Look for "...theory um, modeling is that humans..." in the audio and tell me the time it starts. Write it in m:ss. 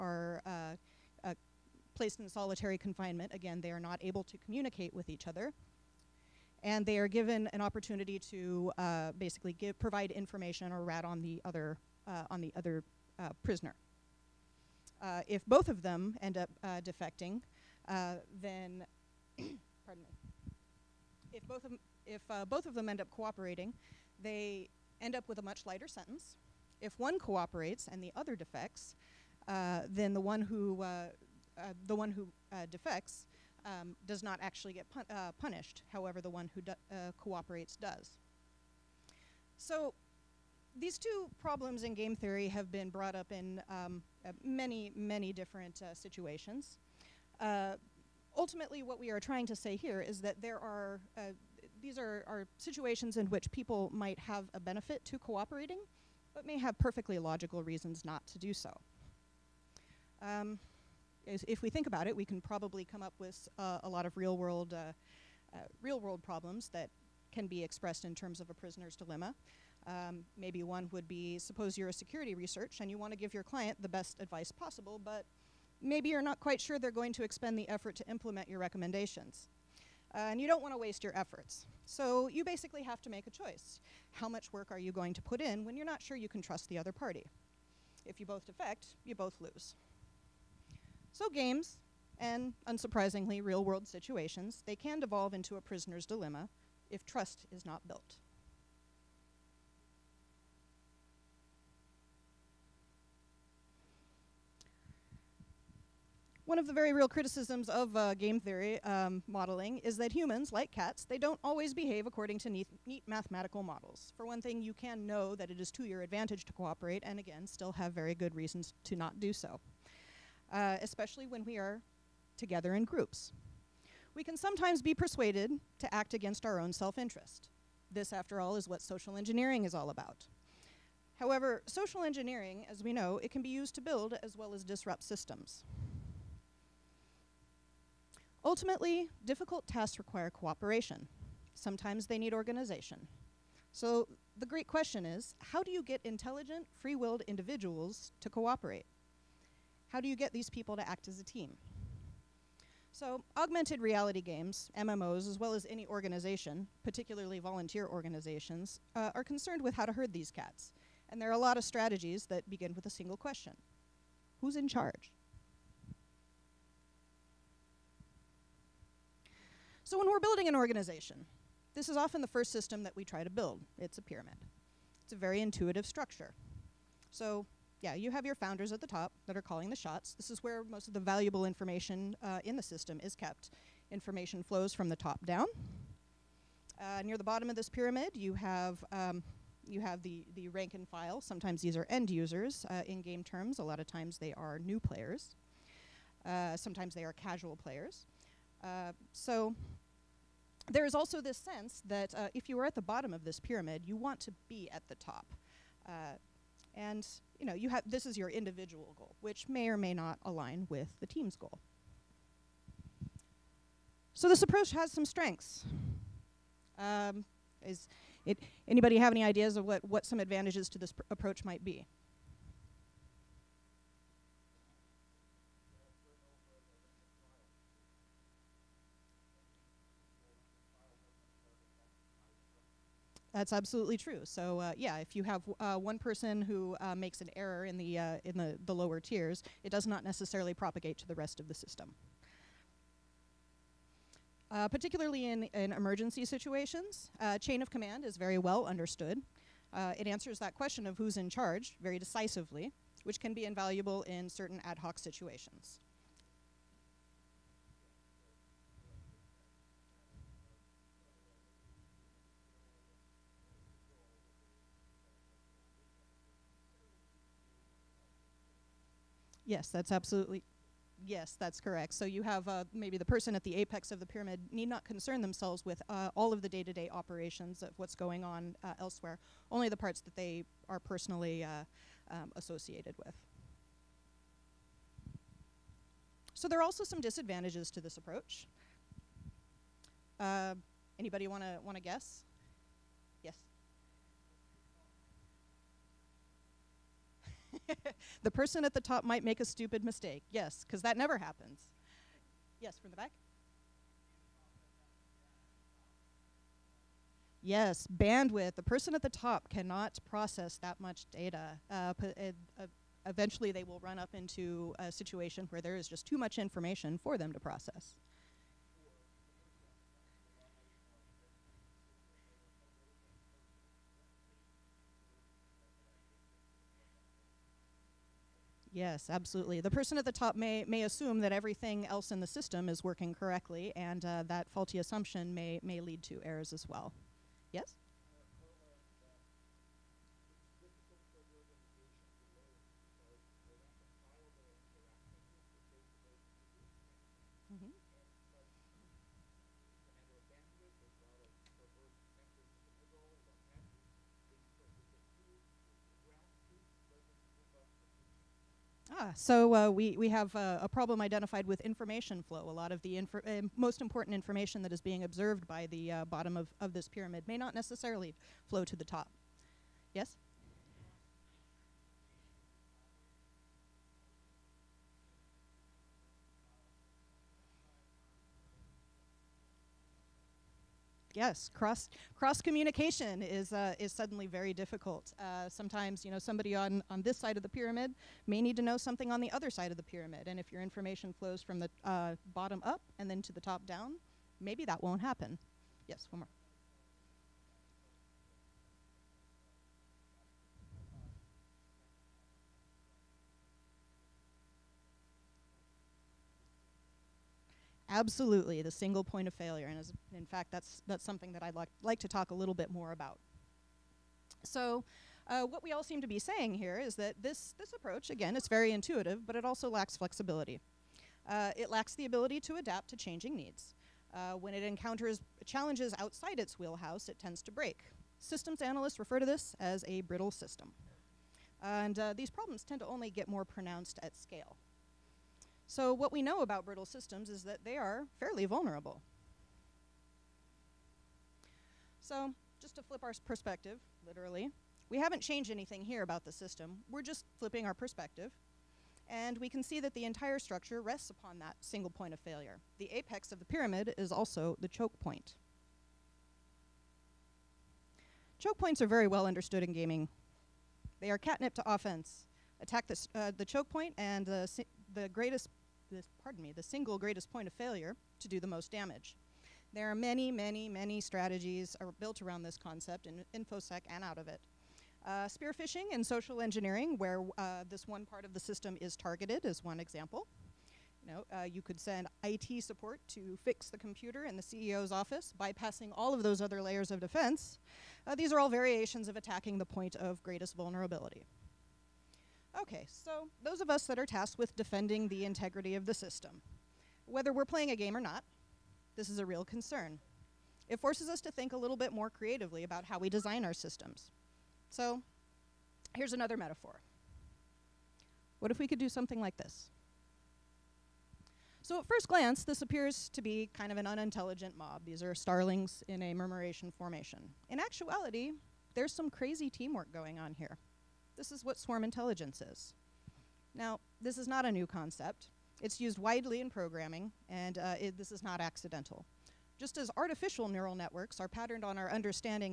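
1:48.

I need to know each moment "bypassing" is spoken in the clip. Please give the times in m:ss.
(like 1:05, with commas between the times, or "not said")
8:05.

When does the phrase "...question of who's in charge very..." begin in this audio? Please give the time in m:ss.
4:10.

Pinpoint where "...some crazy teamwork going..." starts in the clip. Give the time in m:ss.
8:38.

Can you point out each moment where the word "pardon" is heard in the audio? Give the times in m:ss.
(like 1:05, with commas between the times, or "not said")
0:19, 7:46.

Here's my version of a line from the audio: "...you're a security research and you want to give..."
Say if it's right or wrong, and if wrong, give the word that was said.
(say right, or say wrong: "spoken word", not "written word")
right.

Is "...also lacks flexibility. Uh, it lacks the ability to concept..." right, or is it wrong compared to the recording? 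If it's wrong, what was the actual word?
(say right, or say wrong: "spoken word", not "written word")
wrong: "adapt", not "concept".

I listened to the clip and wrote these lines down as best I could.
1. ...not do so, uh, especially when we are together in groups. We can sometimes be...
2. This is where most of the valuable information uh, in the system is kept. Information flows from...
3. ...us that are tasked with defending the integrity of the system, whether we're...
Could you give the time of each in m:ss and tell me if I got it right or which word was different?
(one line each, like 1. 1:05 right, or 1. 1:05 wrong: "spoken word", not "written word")
1. 1:58 right
2. 3:00 right
3. 8:13 right.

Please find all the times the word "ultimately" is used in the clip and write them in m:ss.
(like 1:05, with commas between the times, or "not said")
0:48, 2:18.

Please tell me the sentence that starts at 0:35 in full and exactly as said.
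However, the one who cooperates does.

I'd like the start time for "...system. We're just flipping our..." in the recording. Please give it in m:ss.
7:26.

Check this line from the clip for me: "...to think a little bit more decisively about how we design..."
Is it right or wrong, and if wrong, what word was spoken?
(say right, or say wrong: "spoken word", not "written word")
wrong: "creatively", not "decisively".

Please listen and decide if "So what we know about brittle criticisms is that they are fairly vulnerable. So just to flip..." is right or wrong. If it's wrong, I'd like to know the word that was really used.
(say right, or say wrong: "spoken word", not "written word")
wrong: "systems", not "criticisms".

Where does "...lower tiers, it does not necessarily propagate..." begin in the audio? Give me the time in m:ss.
3:58.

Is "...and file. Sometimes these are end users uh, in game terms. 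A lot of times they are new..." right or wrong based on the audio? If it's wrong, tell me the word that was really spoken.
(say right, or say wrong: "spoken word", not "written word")
right.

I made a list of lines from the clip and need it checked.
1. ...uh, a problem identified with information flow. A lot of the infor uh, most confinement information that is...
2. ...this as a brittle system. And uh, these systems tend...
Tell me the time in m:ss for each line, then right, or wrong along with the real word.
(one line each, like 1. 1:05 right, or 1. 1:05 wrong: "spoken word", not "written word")
1. 6:00 wrong: "important", not "confinement"
2. 7:09 wrong: "problems", not "systems".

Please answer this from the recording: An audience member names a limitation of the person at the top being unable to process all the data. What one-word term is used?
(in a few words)
bandwidth.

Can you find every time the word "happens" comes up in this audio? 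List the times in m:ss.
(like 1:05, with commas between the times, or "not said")
5:01, 6:35.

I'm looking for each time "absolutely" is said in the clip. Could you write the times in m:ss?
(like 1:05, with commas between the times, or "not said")
3:53, 4:29, 5:29, 6:47.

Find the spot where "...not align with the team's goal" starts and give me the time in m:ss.
3:29.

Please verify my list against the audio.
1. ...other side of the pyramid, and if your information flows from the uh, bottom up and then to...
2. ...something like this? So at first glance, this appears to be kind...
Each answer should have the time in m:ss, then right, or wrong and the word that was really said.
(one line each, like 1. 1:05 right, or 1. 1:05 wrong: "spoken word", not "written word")
1. 6:29 right
2. 8:28 right.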